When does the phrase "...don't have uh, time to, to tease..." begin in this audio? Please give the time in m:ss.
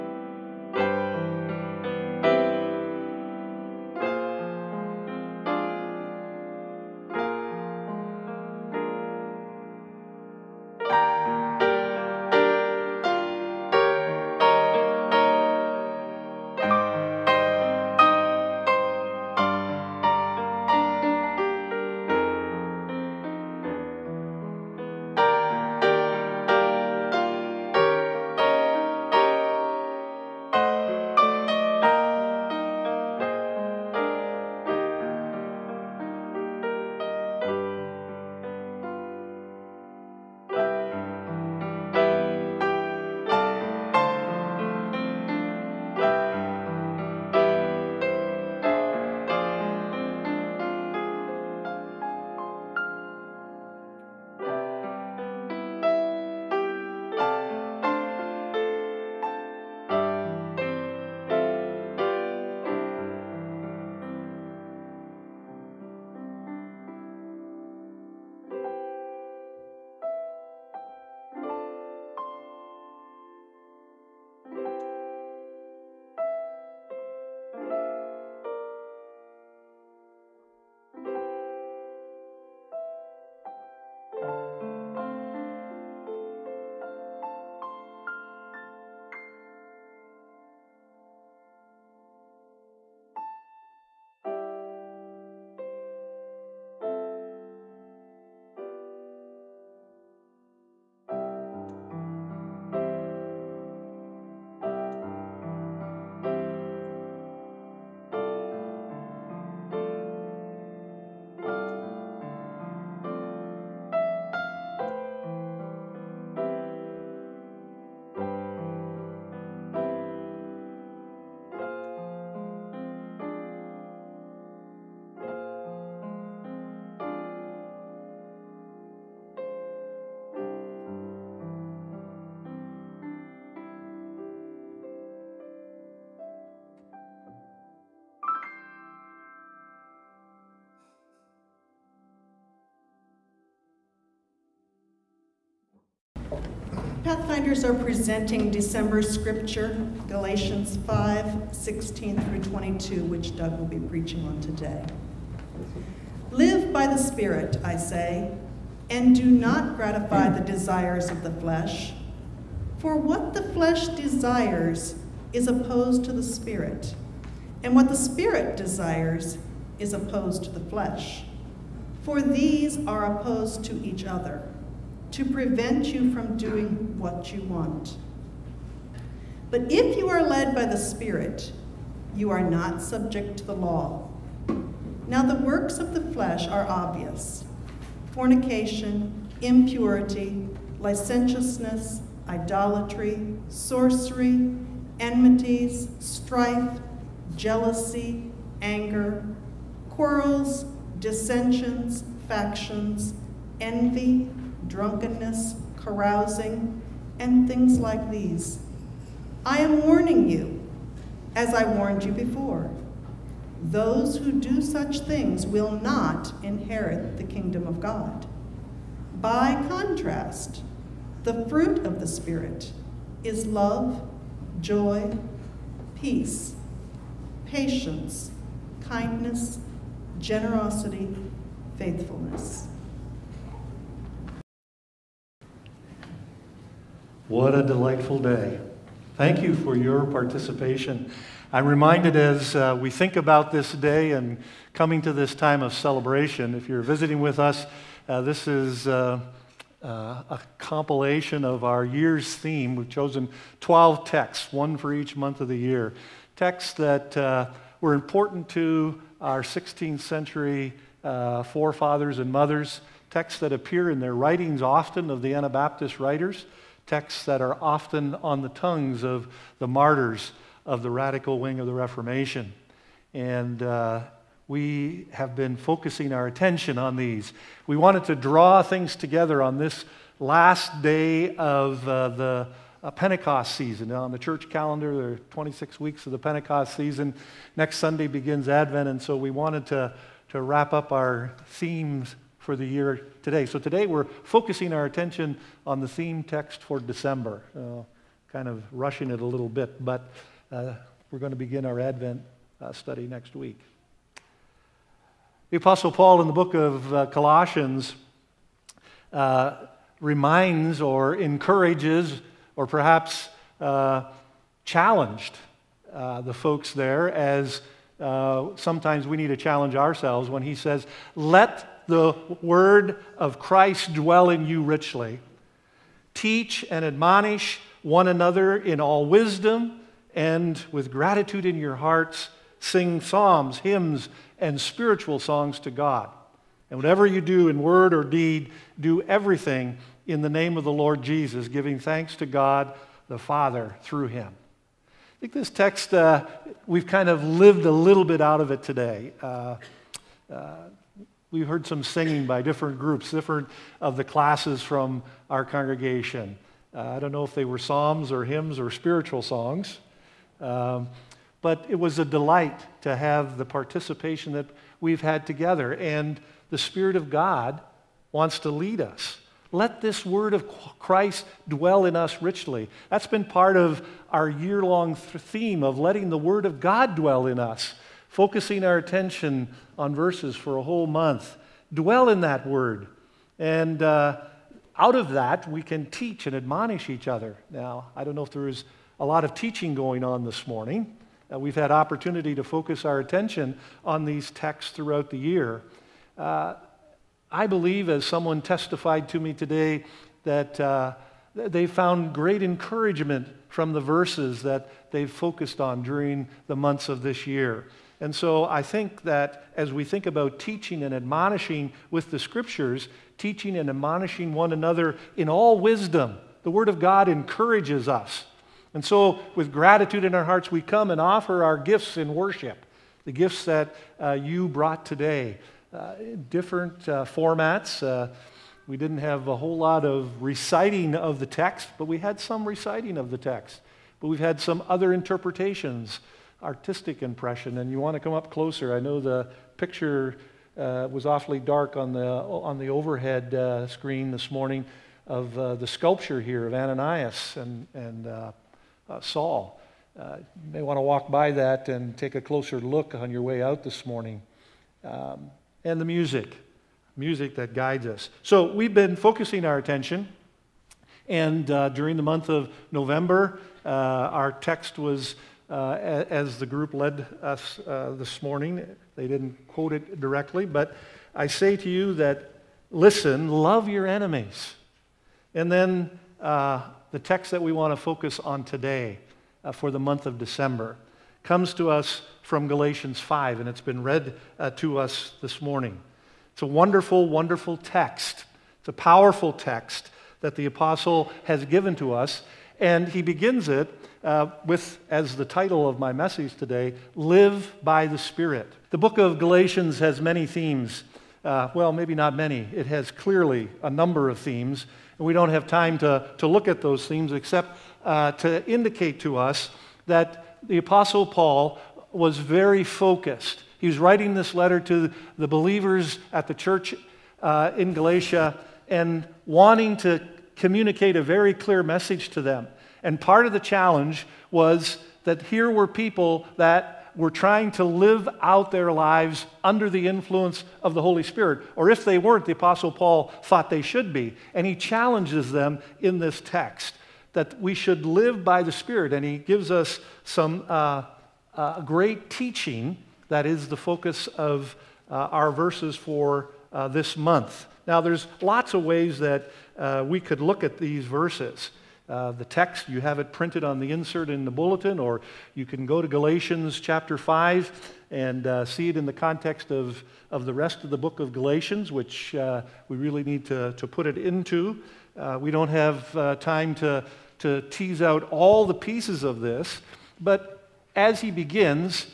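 9:25.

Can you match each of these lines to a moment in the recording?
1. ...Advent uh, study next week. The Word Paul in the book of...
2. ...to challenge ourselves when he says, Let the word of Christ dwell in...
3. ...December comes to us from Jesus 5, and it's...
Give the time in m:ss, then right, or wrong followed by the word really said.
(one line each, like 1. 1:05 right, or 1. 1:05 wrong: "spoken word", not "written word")
1. 5:01 wrong: "Apostle", not "Word"
2. 5:19 right
3. 8:00 wrong: "Galatians", not "Jesus".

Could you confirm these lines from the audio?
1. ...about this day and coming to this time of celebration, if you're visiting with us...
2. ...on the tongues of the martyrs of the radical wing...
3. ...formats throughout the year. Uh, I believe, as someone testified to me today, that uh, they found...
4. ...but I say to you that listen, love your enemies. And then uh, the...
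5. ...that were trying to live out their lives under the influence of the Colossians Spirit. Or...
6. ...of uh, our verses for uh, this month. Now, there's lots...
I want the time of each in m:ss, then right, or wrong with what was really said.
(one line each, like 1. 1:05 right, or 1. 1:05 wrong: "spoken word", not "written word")
1. 4:03 right
2. 4:28 right
3. 6:34 wrong: "texts", not "formats"
4. 7:50 right
5. 8:46 wrong: "Holy", not "Colossians"
6. 9:04 right.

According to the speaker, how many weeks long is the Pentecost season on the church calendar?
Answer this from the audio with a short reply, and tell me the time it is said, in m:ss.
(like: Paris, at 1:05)
26, at 4:45.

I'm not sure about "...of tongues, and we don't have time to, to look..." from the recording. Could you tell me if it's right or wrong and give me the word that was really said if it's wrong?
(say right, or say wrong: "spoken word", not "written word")
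wrong: "themes", not "tongues".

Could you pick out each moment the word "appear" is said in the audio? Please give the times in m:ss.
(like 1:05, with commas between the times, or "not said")
4:23.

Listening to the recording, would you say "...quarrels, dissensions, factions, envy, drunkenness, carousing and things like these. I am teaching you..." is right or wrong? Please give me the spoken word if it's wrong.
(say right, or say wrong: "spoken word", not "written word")
wrong: "warning", not "teaching".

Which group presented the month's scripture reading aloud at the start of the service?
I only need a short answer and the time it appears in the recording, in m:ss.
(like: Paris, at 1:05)
Pathfinders, at 2:27.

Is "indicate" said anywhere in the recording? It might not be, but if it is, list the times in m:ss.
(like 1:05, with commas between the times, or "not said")
8:28.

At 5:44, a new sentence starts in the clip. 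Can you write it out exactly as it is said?
I think this text, uh, we've kind of lived a little bit out of it today.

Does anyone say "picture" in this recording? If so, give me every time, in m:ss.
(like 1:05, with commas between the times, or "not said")
7:19.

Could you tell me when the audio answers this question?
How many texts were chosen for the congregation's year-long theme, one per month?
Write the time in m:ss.
4:13.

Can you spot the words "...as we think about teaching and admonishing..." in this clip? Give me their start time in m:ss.
6:49.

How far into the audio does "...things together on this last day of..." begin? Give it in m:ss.
4:38.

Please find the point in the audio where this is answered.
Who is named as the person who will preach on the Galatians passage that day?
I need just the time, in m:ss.
2:33.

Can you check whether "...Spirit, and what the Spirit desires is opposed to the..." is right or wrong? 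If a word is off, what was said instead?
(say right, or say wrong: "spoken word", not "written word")
right.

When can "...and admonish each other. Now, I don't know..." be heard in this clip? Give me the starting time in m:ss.
6:26.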